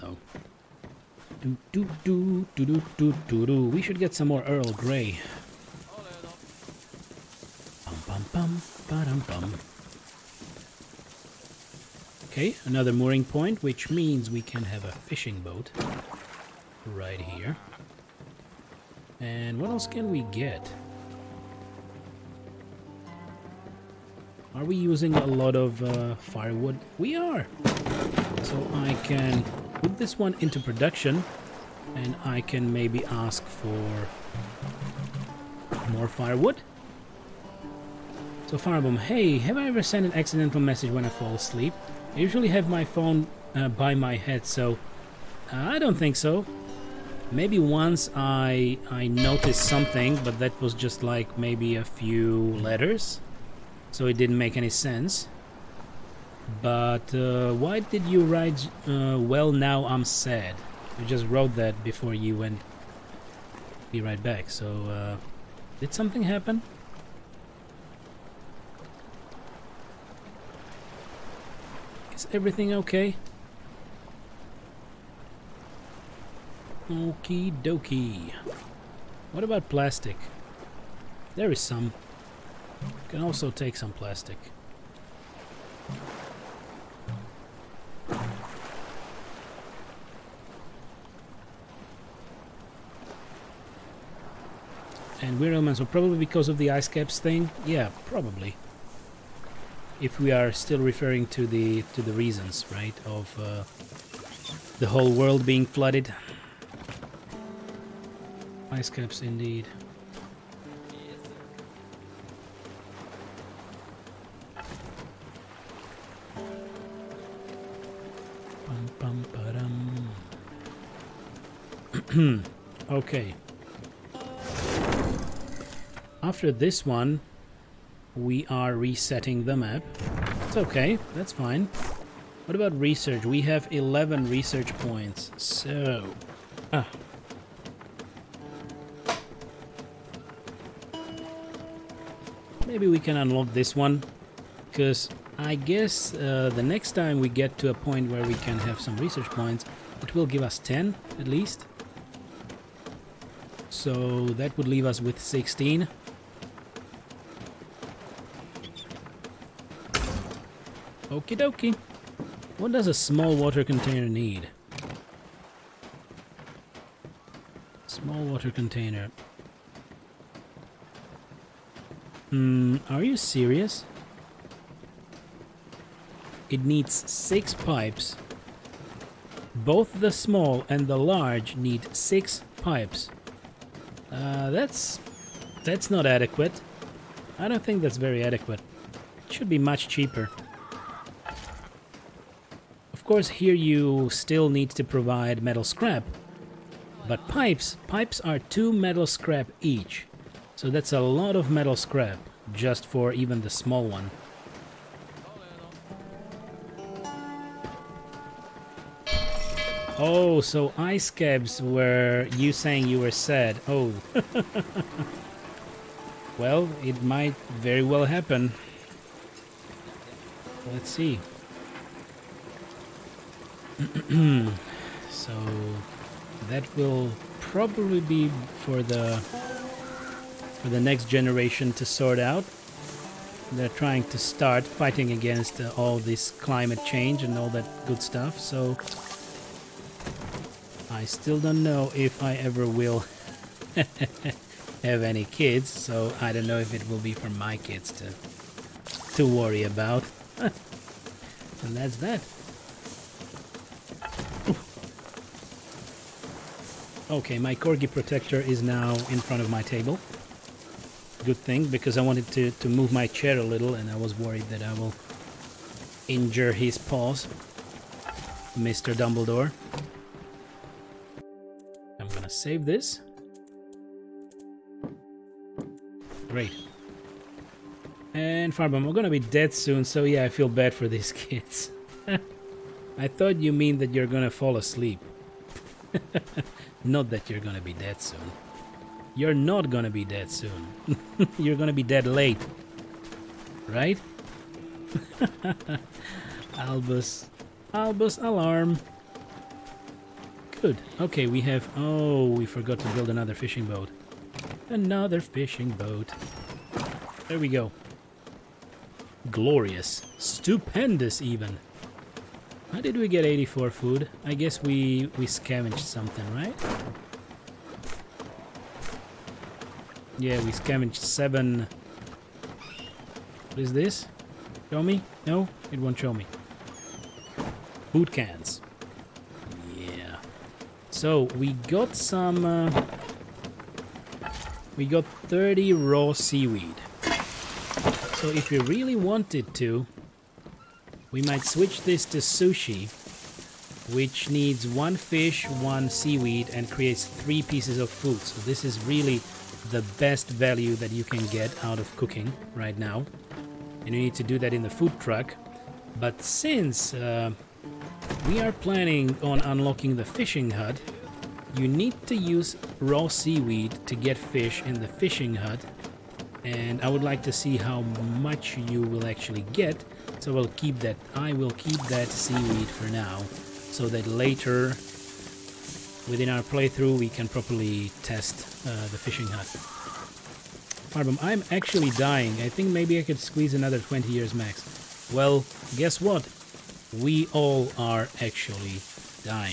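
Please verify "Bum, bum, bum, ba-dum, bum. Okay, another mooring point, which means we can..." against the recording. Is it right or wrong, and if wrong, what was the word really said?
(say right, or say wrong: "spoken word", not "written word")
right.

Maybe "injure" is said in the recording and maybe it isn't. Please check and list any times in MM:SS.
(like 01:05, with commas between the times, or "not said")
04:26.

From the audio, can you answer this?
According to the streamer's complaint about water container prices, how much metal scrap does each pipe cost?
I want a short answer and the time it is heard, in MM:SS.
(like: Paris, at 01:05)
2, at 03:18.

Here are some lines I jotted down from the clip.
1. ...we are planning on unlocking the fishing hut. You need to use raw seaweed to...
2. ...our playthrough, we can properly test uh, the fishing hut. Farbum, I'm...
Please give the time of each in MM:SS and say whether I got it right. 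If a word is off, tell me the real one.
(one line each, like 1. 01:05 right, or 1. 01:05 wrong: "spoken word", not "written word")
1. 05:58 right
2. 06:16 right.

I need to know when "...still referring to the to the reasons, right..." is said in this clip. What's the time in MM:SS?
01:40.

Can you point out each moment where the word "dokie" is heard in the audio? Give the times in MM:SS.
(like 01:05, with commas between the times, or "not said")
01:17, 02:41.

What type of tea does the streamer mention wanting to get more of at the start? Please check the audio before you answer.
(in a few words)
Earl Grey.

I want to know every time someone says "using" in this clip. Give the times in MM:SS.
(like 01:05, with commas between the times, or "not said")
00:24.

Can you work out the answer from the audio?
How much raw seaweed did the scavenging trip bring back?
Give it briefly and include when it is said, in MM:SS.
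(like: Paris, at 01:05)
30, at 05:35.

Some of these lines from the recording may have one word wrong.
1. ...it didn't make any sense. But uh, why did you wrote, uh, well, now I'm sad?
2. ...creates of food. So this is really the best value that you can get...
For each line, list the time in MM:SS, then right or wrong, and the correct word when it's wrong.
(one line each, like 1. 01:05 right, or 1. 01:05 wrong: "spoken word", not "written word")
1. 00:54 wrong: "write", not "wrote"
2. 05:47 wrong: "pieces", not "creates".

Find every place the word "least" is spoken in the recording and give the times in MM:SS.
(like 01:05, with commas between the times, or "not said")
02:31.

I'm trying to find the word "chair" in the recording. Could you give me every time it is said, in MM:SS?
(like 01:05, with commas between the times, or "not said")
04:23.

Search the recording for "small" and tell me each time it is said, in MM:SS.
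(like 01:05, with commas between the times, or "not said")
02:42, 02:47, 03:00, 03:23.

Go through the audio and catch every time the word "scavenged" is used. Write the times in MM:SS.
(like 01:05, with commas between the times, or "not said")
05:15, 05:20.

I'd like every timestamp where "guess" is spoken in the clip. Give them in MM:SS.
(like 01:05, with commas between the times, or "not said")
02:25, 05:14, 06:25.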